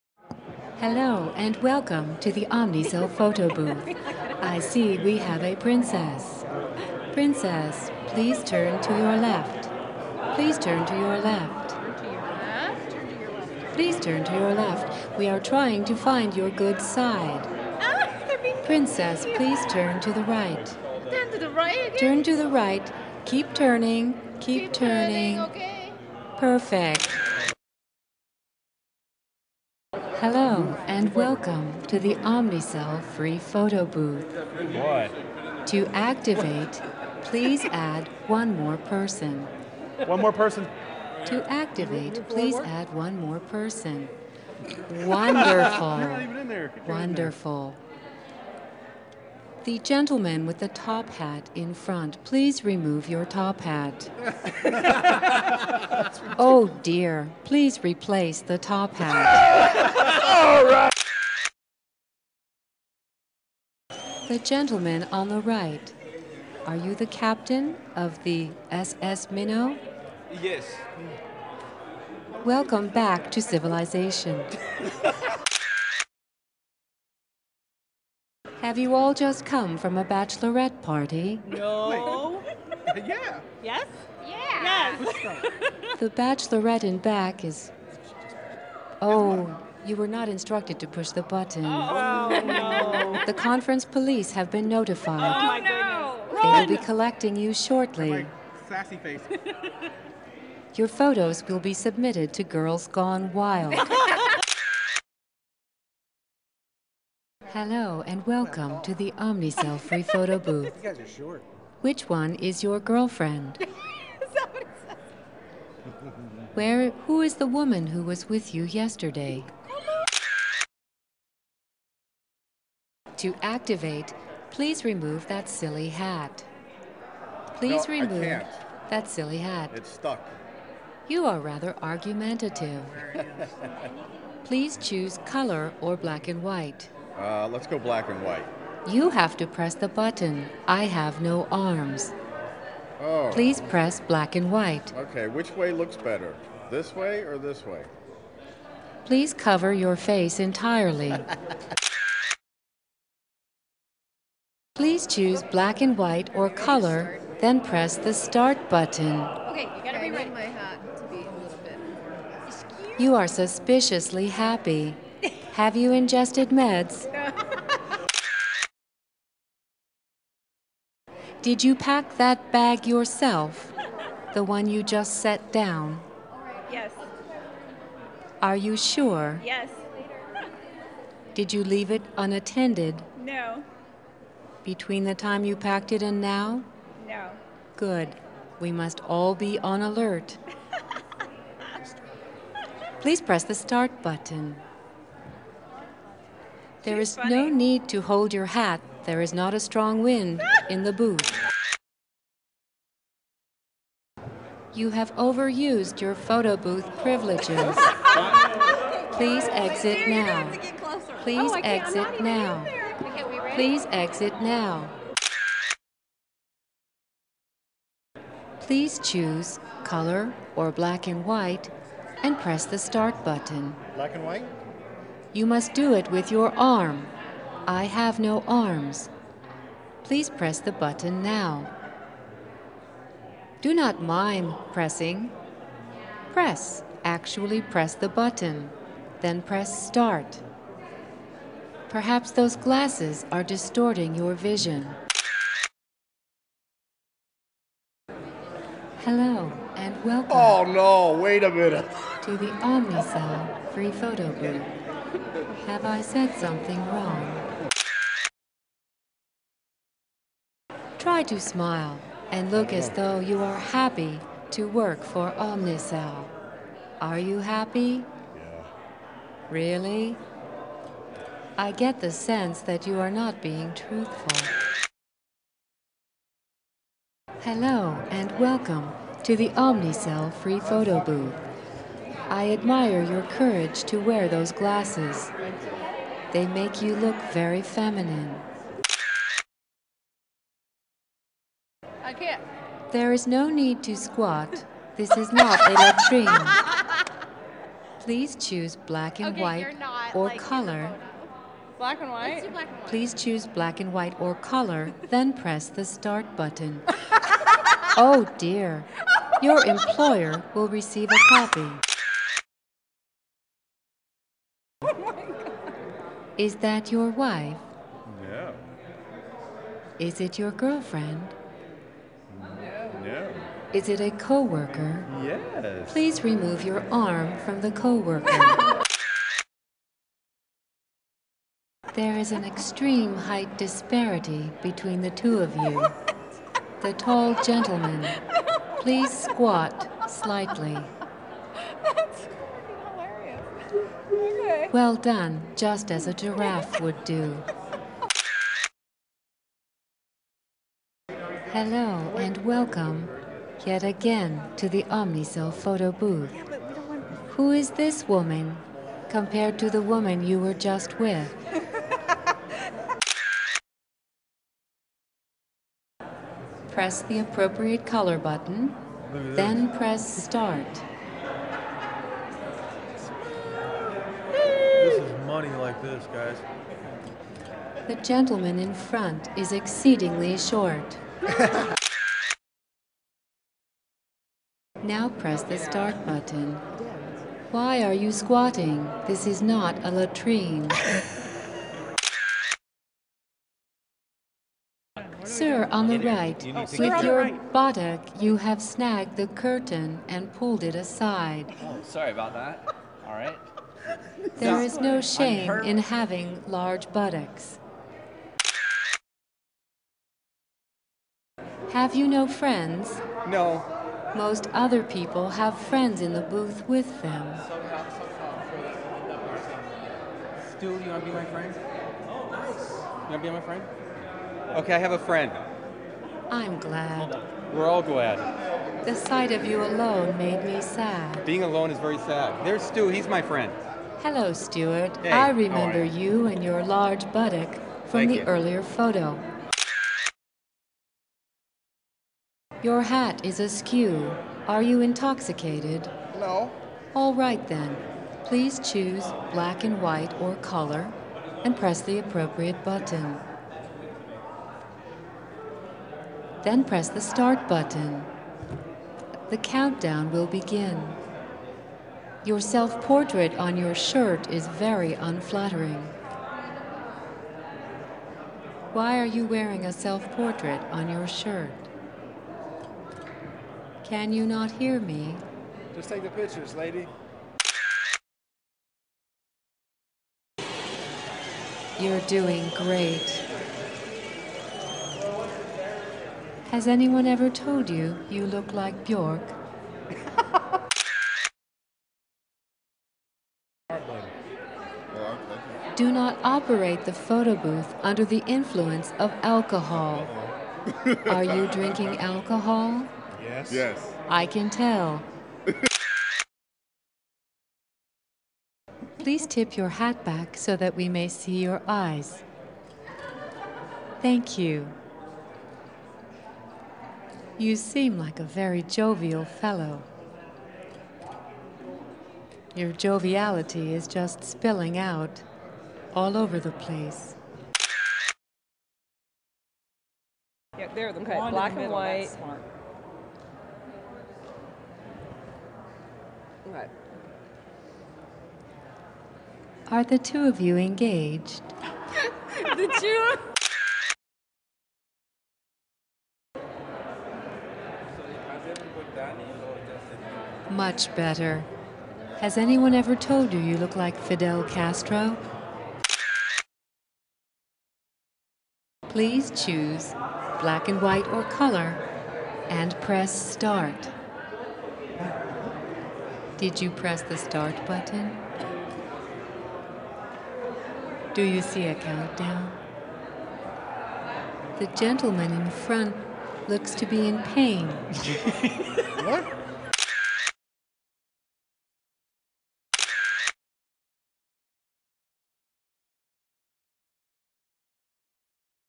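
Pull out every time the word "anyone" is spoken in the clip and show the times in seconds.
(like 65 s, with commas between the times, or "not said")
486 s, 552 s.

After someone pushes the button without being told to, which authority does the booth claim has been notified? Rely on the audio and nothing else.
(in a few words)
The conference police.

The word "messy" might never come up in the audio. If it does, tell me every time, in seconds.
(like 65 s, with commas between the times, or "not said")
not said.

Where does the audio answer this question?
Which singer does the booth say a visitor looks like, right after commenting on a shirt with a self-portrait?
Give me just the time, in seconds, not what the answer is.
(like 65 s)
488 s.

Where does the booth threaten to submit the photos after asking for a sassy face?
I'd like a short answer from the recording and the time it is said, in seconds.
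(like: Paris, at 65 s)
Girls Gone Wild, at 102 s.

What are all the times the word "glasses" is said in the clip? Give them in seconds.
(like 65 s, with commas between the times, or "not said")
242 s, 284 s.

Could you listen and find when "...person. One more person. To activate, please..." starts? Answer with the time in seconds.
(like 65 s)
38 s.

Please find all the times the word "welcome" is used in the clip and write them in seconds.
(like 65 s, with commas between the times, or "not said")
1 s, 31 s, 72 s, 108 s, 250 s, 278 s, 352 s.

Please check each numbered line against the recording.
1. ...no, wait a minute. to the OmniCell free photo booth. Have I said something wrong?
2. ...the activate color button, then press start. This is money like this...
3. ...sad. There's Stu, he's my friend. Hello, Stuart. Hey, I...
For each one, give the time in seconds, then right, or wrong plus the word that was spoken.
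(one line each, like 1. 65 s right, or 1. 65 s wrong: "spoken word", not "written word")
1. 250 s right
2. 367 s wrong: "appropriate", not "activate"
3. 431 s right.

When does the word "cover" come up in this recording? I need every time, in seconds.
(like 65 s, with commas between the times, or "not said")
149 s.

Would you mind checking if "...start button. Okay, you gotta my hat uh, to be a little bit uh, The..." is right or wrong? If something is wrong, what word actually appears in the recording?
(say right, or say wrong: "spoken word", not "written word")
wrong: "You", not "The".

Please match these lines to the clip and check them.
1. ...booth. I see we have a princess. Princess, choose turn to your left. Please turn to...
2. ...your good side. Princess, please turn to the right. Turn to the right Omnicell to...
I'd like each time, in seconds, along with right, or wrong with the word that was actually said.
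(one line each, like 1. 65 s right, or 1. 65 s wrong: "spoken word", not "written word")
1. 3 s wrong: "please", not "choose"
2. 16 s wrong: "Turn", not "Omnicell".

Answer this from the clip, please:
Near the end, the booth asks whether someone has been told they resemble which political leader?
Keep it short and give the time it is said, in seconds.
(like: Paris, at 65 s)
Fidel Castro, at 554 s.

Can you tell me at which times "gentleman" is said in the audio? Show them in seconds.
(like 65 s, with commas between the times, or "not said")
49 s, 64 s, 337 s, 378 s, 574 s.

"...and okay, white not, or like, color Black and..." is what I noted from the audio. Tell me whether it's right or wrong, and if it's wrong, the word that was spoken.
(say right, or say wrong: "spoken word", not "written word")
right.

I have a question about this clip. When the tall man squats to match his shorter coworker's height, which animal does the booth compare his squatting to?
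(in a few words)
A giraffe.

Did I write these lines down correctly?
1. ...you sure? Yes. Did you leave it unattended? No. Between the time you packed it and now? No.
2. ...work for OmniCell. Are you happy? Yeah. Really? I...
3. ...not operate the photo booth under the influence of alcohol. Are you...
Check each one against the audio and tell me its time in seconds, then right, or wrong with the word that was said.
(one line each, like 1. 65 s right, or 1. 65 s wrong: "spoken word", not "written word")
1. 178 s right
2. 264 s right
3. 495 s right.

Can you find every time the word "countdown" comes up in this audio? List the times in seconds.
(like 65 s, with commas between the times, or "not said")
459 s, 571 s.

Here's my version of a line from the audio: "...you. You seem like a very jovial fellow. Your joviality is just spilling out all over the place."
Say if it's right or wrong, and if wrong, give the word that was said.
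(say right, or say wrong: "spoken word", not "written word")
right.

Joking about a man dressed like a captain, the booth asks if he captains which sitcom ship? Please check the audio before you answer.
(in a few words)
SS Minnow.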